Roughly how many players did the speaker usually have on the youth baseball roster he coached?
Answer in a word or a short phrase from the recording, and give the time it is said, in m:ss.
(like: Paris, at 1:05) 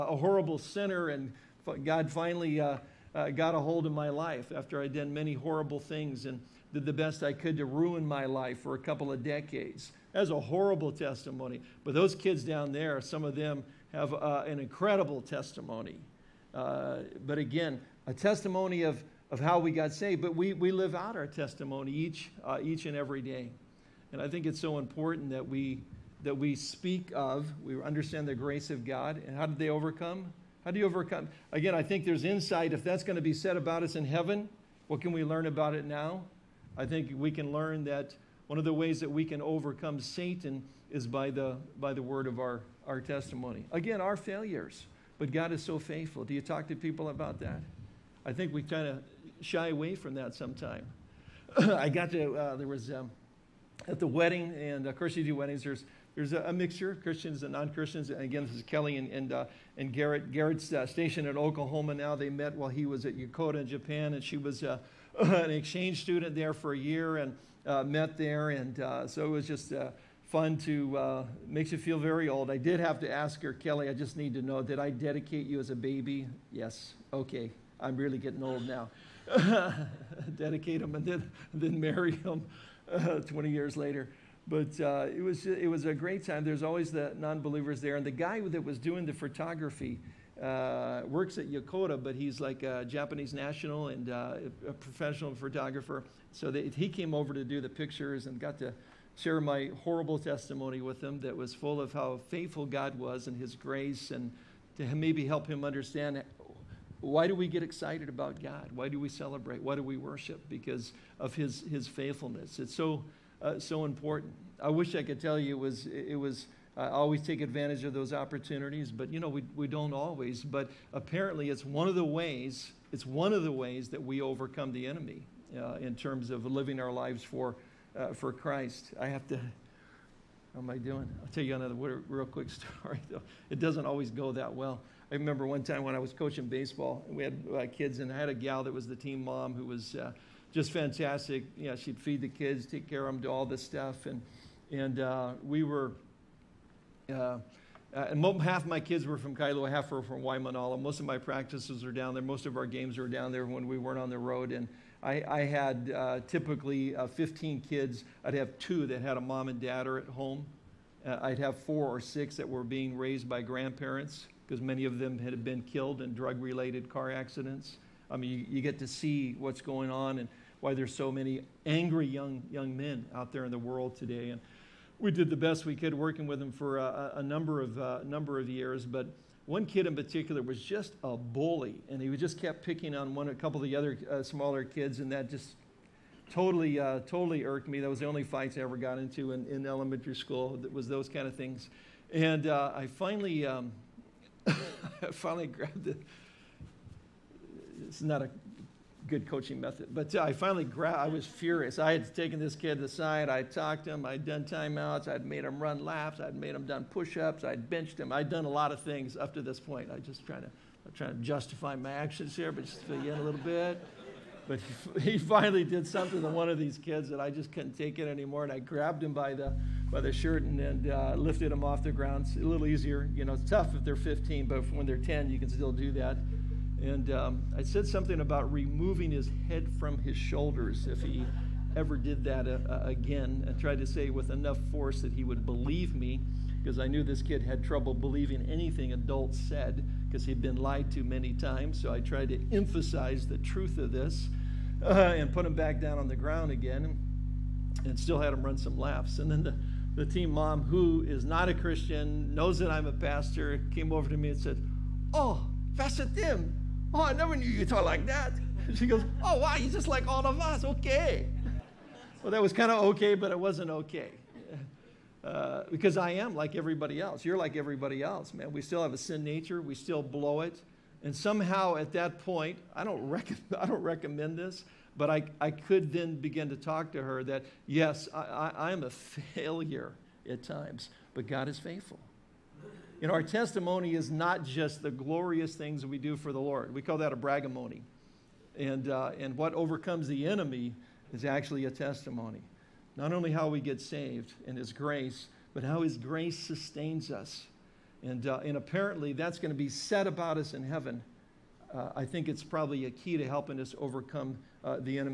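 15, at 2:37.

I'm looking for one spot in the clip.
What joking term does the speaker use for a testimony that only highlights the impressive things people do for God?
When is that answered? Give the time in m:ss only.
4:47.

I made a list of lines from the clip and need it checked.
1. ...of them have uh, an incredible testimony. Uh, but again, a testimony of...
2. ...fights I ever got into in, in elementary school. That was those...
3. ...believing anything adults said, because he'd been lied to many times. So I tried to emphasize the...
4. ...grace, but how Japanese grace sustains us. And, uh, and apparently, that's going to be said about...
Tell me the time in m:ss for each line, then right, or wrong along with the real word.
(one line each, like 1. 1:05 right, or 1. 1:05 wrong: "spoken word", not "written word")
1. 0:13 right
2. 3:08 right
3. 3:57 right
4. 4:54 wrong: "His", not "Japanese".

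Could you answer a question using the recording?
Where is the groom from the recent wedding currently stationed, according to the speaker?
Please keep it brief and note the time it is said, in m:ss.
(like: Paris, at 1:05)
Oklahoma, at 1:01.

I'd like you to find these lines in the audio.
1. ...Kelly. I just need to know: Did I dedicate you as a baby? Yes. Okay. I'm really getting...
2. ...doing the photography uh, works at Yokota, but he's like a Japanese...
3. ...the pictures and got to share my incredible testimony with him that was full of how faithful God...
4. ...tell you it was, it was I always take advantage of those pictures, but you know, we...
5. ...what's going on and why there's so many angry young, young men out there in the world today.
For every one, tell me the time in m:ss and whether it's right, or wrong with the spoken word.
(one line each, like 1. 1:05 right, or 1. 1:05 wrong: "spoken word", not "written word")
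1. 1:13 right
2. 1:28 right
3. 1:37 wrong: "horrible", not "incredible"
4. 1:55 wrong: "opportunities", not "pictures"
5. 2:49 right.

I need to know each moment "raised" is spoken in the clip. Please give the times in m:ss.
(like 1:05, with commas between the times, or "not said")
2:42.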